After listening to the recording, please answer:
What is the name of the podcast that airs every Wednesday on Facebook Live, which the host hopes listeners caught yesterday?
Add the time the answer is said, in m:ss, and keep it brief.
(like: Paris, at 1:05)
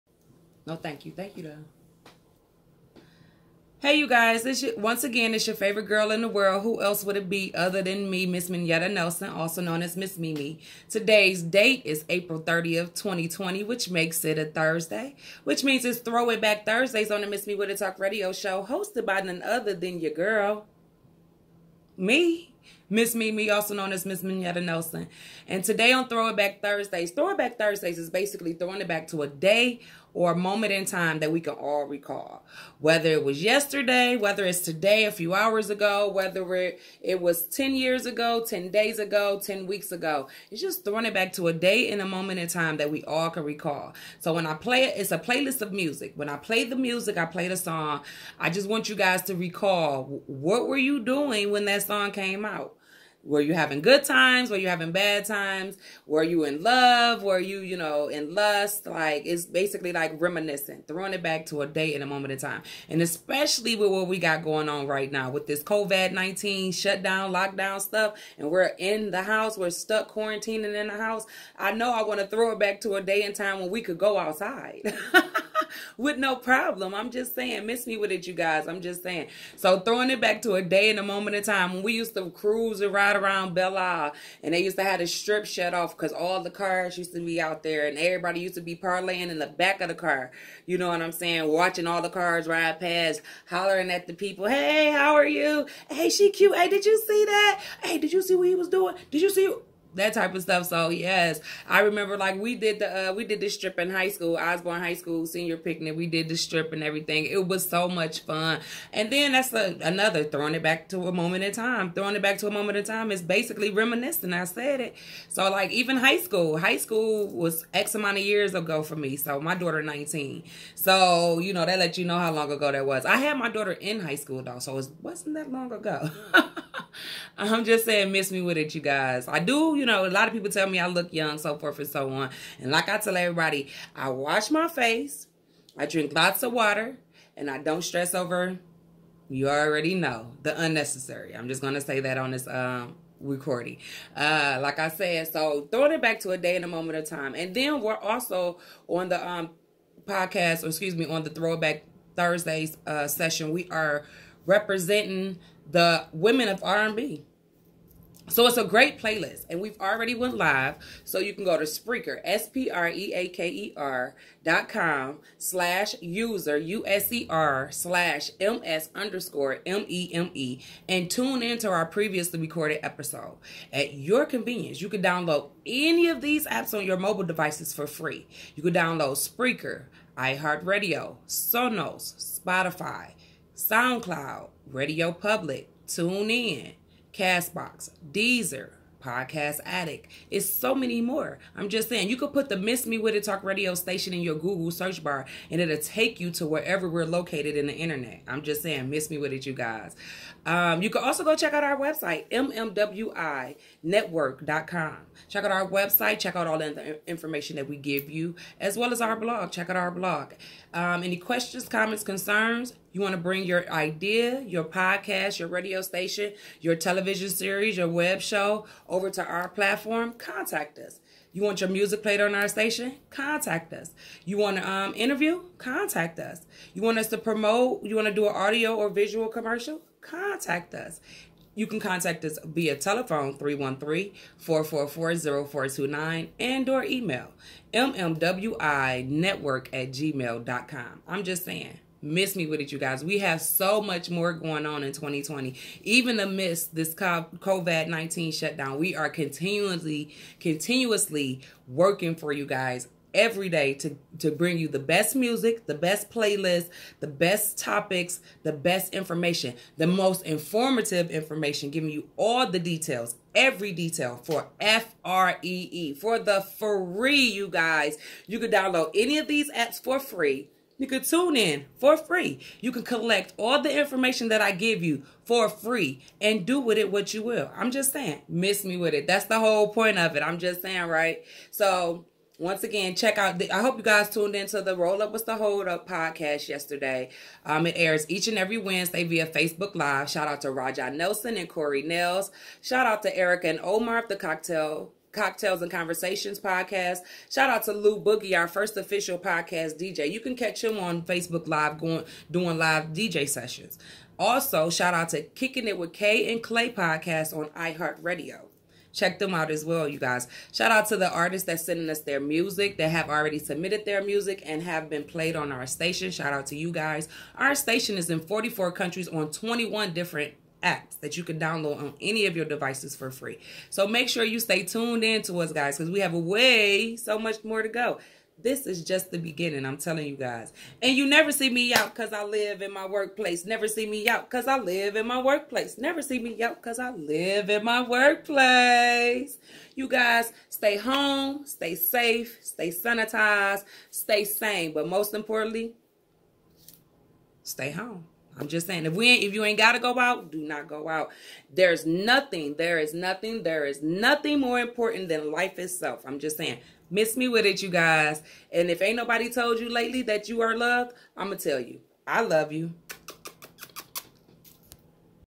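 Roll Up with the Hold Up, at 4:44.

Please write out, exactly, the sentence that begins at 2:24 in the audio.
Uh, like I said, so throwing it back to a day and a moment of time.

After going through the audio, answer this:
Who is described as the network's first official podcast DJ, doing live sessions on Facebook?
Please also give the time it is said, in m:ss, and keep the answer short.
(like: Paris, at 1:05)
Lou Boogie, at 4:57.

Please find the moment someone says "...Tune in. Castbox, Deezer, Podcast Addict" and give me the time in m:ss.
3:05.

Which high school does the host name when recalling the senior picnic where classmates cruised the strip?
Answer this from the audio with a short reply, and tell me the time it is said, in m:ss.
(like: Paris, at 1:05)
Osborn High School, at 1:44.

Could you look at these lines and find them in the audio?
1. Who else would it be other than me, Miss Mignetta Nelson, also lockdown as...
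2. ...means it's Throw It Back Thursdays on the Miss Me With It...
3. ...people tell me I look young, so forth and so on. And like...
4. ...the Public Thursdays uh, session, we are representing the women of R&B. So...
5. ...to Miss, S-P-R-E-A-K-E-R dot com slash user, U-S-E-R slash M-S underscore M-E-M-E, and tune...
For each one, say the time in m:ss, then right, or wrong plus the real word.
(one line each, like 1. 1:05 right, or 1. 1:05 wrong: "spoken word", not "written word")
1. 0:06 wrong: "known", not "lockdown"
2. 0:15 right
3. 2:10 right
4. 2:31 wrong: "Throwback", not "Public"
5. 2:41 wrong: "Spreaker", not "Miss".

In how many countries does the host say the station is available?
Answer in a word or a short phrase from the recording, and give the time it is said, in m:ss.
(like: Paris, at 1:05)
44, at 5:18.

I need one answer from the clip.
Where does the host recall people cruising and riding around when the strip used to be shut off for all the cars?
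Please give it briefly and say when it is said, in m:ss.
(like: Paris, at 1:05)
Belle Isle, at 1:23.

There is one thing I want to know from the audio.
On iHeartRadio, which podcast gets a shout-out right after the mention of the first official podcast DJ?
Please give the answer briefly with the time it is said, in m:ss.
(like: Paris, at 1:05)
Kicking It with Kay and Clay, at 5:05.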